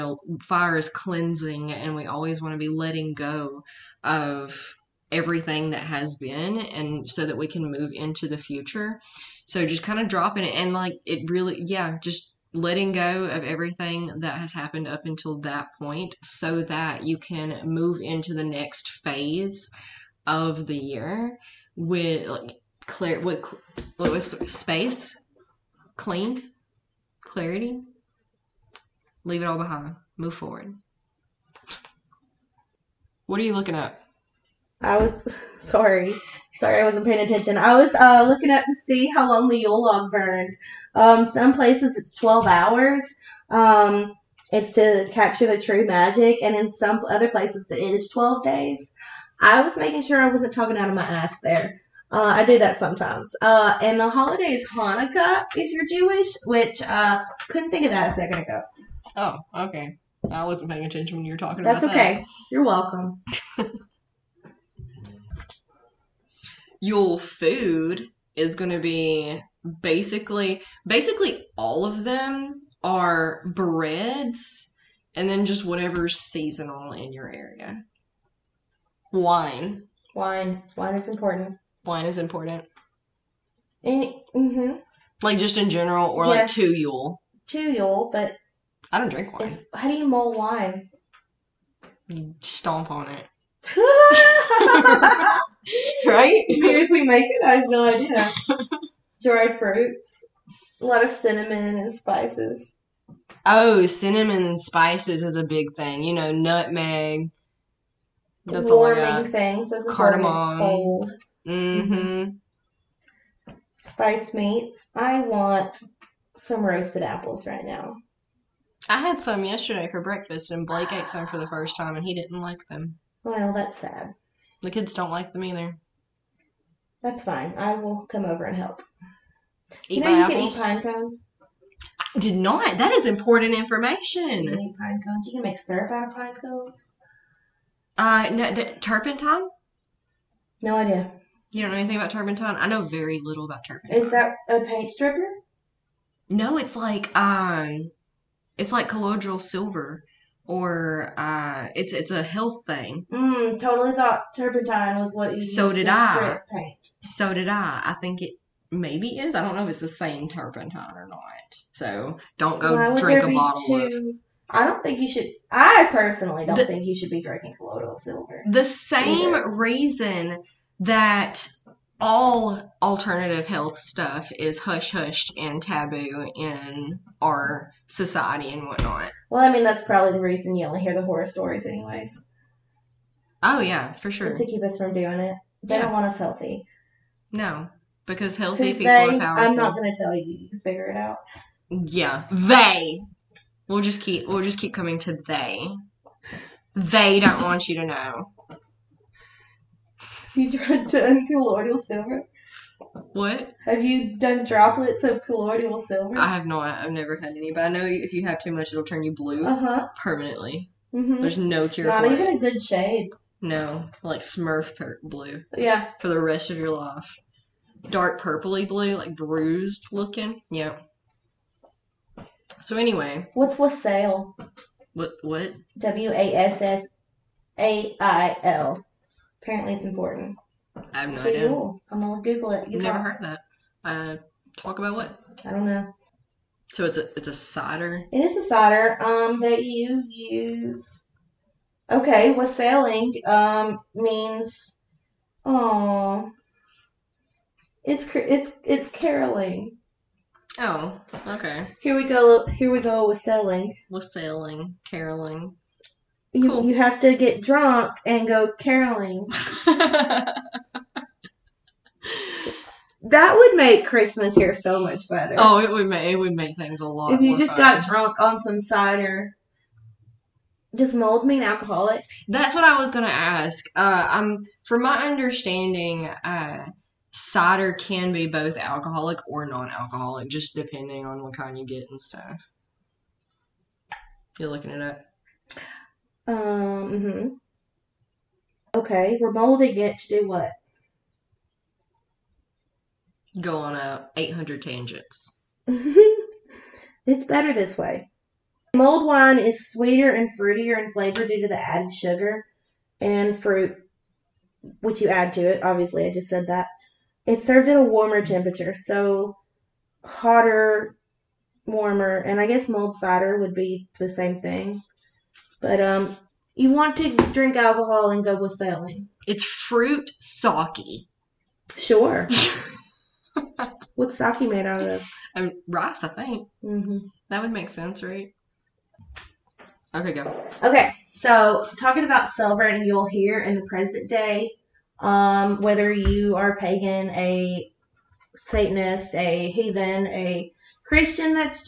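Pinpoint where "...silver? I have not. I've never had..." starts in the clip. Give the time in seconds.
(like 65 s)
205 s.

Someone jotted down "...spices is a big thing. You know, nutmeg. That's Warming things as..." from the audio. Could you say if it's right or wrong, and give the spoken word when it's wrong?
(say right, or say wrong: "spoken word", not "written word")
right.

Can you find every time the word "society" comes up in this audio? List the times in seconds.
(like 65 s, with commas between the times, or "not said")
177 s.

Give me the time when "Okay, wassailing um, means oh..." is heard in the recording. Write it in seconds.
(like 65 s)
241 s.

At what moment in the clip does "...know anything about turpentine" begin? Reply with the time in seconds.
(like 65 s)
141 s.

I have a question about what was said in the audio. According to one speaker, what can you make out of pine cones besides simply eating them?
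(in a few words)
syrup.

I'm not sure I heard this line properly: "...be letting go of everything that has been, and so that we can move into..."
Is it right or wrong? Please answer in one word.
right.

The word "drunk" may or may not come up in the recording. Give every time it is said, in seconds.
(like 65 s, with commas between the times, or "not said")
257 s, 267 s.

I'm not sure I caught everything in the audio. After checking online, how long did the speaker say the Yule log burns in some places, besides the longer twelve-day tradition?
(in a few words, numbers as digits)
12 hours.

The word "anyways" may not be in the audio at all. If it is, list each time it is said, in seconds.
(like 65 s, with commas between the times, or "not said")
181 s, 222 s.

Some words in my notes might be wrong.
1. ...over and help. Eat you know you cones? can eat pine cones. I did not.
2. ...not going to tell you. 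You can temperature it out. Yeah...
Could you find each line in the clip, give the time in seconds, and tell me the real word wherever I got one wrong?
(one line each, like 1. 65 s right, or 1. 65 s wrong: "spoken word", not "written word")
1. 128 s wrong: "apples", not "cones"
2. 189 s wrong: "figure", not "temperature".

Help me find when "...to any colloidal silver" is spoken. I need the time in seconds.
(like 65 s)
200 s.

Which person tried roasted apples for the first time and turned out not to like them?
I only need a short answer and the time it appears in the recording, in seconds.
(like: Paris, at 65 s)
Blake, at 120 s.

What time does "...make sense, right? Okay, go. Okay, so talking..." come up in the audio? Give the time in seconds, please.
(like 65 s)
327 s.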